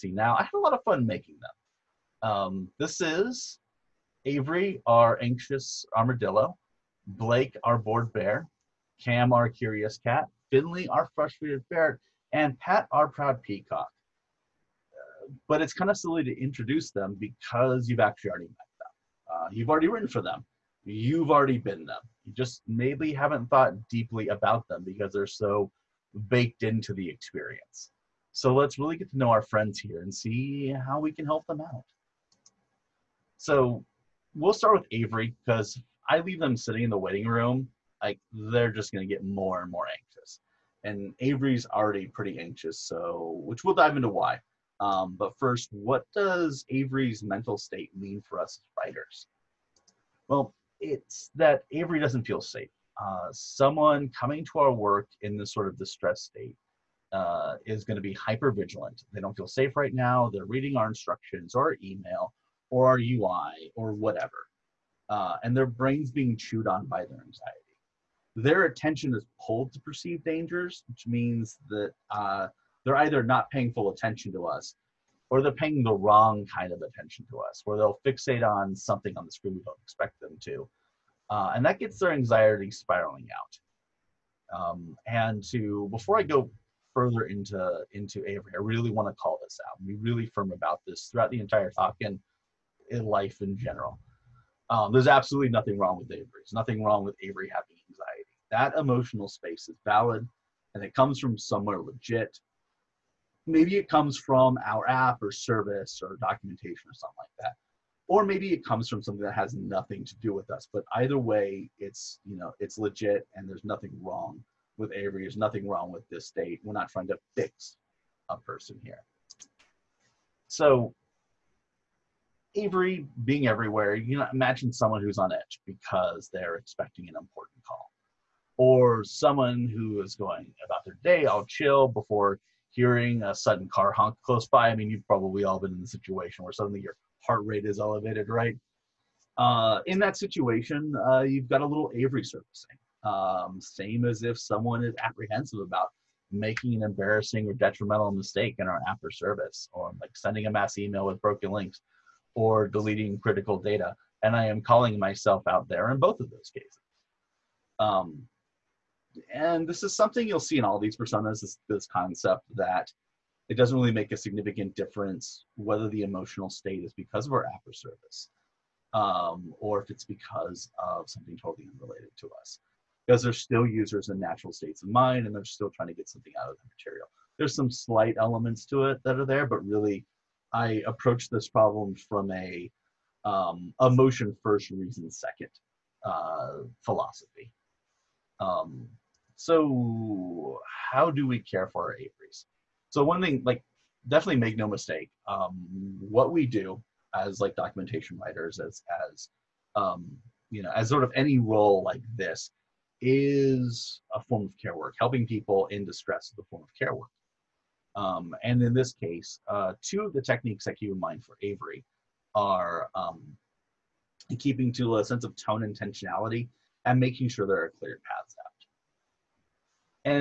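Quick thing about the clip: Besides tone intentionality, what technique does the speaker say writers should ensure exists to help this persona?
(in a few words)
clear paths out.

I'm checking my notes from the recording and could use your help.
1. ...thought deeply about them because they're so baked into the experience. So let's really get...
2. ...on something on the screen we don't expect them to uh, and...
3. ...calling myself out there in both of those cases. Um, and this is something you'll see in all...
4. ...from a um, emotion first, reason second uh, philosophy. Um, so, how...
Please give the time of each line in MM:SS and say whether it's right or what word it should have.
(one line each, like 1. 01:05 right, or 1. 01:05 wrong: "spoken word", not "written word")
1. 00:23 right
2. 01:18 right
3. 02:34 right
4. 03:02 right.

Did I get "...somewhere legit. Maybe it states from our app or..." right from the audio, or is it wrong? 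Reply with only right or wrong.
wrong.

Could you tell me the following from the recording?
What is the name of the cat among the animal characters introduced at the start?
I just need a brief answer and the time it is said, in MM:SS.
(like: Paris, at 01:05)
Cam, at 00:09.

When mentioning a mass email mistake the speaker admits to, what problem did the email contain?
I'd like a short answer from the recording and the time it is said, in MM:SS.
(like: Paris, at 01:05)
broken links, at 02:31.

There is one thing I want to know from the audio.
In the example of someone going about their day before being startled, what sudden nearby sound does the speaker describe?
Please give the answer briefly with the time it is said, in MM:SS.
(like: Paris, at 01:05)
car honk, at 02:13.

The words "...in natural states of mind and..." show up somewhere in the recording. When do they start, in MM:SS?
02:54.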